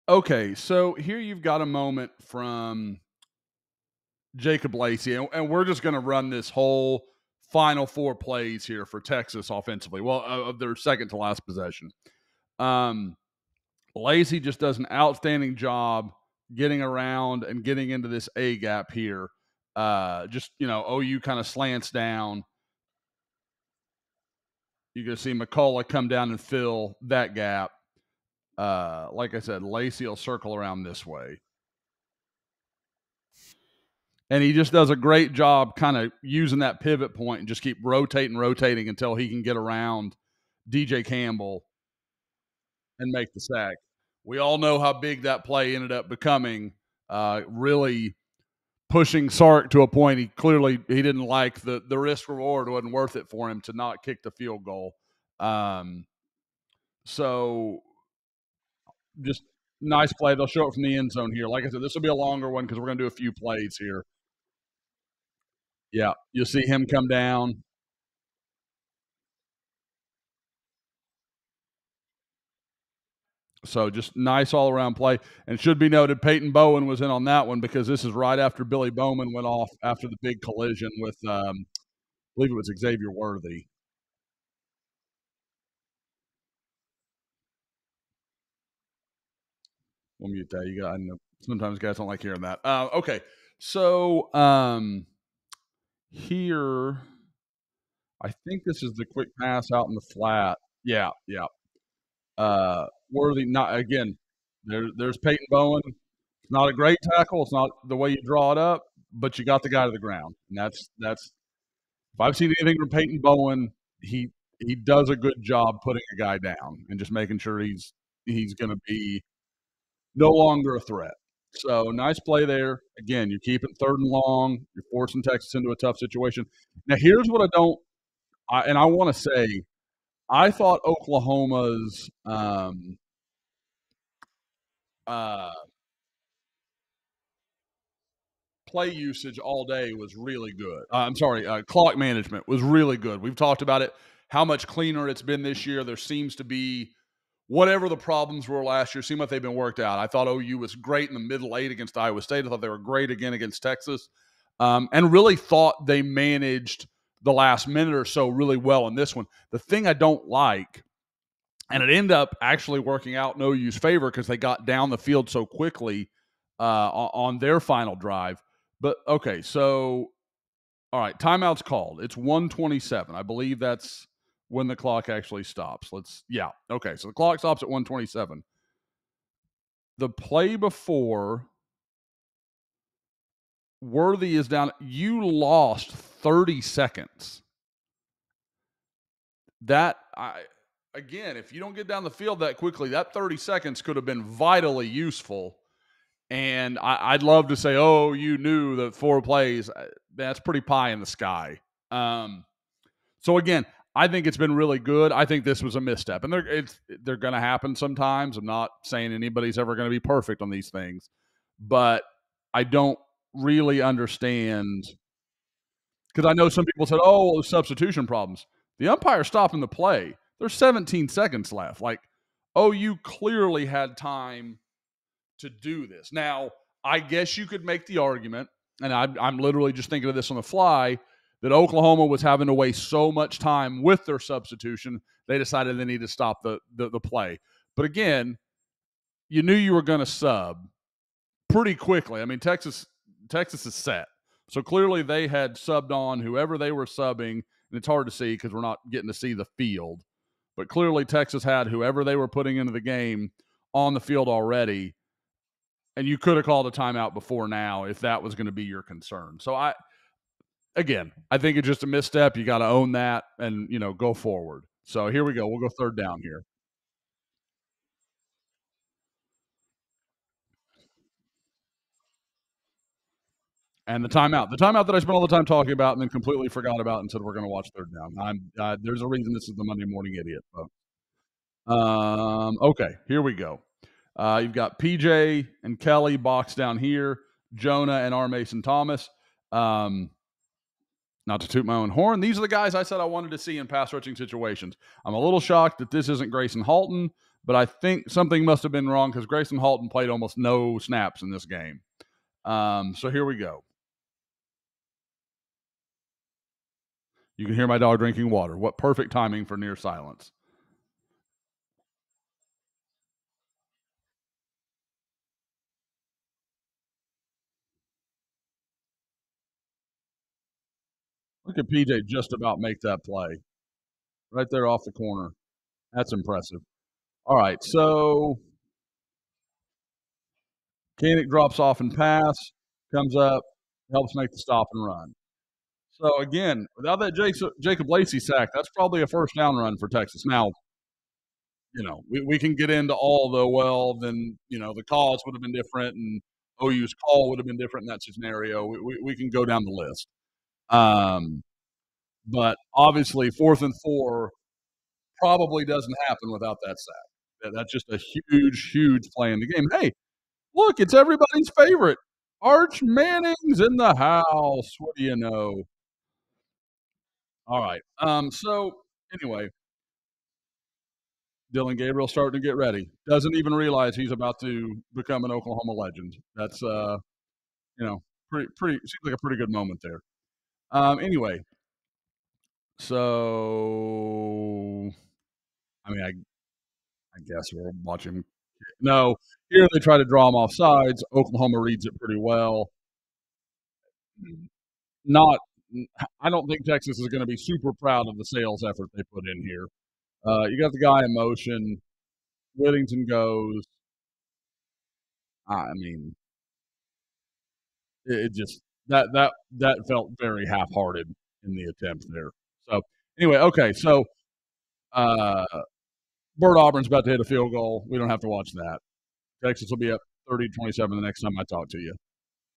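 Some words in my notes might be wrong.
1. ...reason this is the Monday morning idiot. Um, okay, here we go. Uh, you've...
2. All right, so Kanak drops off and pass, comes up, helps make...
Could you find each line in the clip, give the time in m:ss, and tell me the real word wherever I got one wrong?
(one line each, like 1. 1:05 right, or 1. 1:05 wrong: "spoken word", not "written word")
1. 4:39 right
2. 5:27 right.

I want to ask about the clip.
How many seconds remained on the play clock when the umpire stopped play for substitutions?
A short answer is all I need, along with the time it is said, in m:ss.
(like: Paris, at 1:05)
17, at 3:40.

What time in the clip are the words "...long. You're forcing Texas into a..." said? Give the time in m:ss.
2:04.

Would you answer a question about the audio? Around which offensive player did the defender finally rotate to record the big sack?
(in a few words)
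DJ Campbell.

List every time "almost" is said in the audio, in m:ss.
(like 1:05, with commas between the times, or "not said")
5:00.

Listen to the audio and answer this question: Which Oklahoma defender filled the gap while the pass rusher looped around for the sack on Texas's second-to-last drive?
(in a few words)
McCullough.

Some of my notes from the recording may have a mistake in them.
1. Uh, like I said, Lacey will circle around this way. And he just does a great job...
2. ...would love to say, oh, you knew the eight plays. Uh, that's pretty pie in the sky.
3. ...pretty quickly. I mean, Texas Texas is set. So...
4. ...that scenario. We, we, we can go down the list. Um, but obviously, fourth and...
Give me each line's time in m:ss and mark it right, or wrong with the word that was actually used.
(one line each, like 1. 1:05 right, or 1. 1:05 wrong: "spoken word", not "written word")
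1. 0:28 right
2. 3:17 wrong: "four", not "eight"
3. 4:01 right
4. 5:47 right.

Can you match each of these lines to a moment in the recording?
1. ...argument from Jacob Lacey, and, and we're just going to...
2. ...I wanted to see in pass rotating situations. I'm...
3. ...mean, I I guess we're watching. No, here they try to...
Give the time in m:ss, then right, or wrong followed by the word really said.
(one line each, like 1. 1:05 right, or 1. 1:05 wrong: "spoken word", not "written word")
1. 0:01 wrong: "moment", not "argument"
2. 4:52 wrong: "rushing", not "rotating"
3. 6:25 right.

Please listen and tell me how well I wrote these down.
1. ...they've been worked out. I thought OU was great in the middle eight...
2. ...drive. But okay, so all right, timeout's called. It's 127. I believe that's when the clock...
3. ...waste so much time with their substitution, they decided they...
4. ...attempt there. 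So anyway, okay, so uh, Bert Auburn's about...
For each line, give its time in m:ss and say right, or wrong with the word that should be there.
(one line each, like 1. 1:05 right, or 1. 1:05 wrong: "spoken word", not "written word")
1. 2:29 right
2. 2:47 right
3. 3:52 right
4. 6:51 right.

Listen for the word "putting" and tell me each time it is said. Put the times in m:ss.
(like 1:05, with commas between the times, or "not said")
1:55, 4:12.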